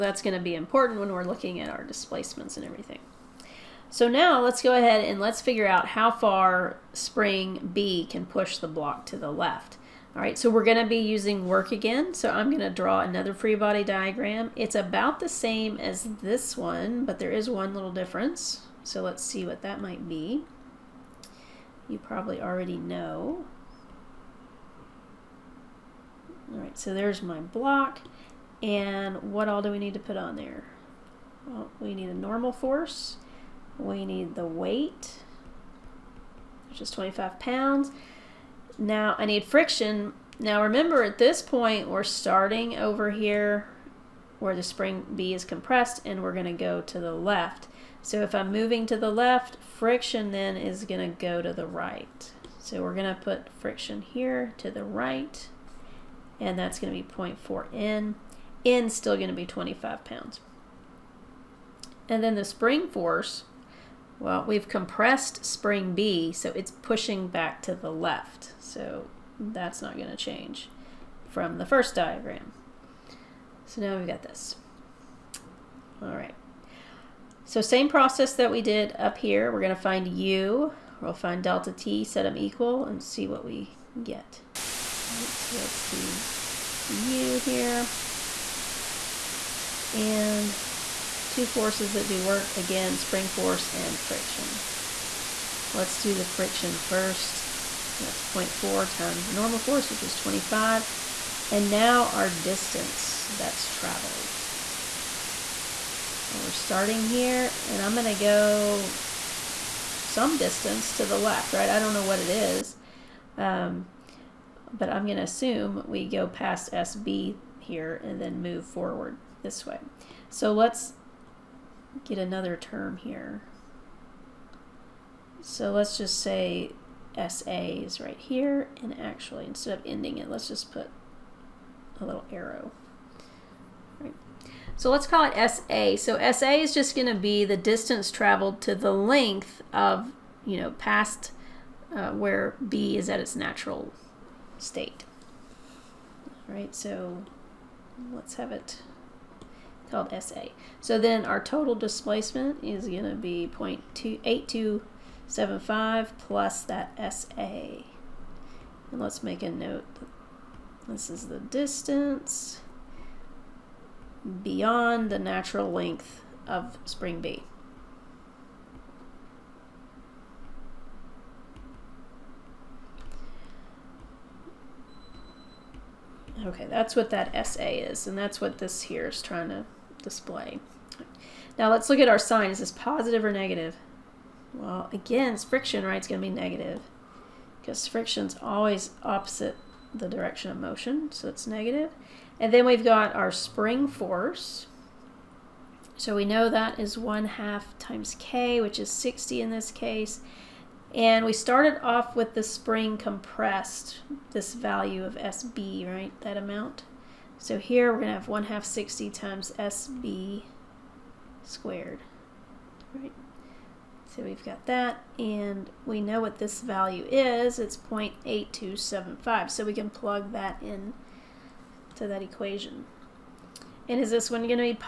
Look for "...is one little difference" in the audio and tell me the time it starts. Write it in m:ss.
0:17.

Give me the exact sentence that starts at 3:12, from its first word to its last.
And then we've got our spring force.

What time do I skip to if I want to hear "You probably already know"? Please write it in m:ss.
0:21.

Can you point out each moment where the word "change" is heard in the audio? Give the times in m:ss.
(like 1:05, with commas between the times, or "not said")
1:10.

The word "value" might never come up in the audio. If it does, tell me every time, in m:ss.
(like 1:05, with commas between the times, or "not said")
3:24, 3:36.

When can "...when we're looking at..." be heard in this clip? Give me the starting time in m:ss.
0:00.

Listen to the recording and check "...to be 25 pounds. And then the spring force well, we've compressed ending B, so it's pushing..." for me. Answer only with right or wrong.
wrong.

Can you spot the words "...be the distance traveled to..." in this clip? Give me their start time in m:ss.
2:17.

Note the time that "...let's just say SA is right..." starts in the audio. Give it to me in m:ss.
2:05.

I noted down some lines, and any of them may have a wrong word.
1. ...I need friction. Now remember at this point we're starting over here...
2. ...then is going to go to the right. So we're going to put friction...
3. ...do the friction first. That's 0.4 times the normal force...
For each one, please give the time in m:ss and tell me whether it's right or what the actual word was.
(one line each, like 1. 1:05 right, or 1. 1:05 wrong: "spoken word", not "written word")
1. 0:39 right
2. 0:50 right
3. 1:35 right.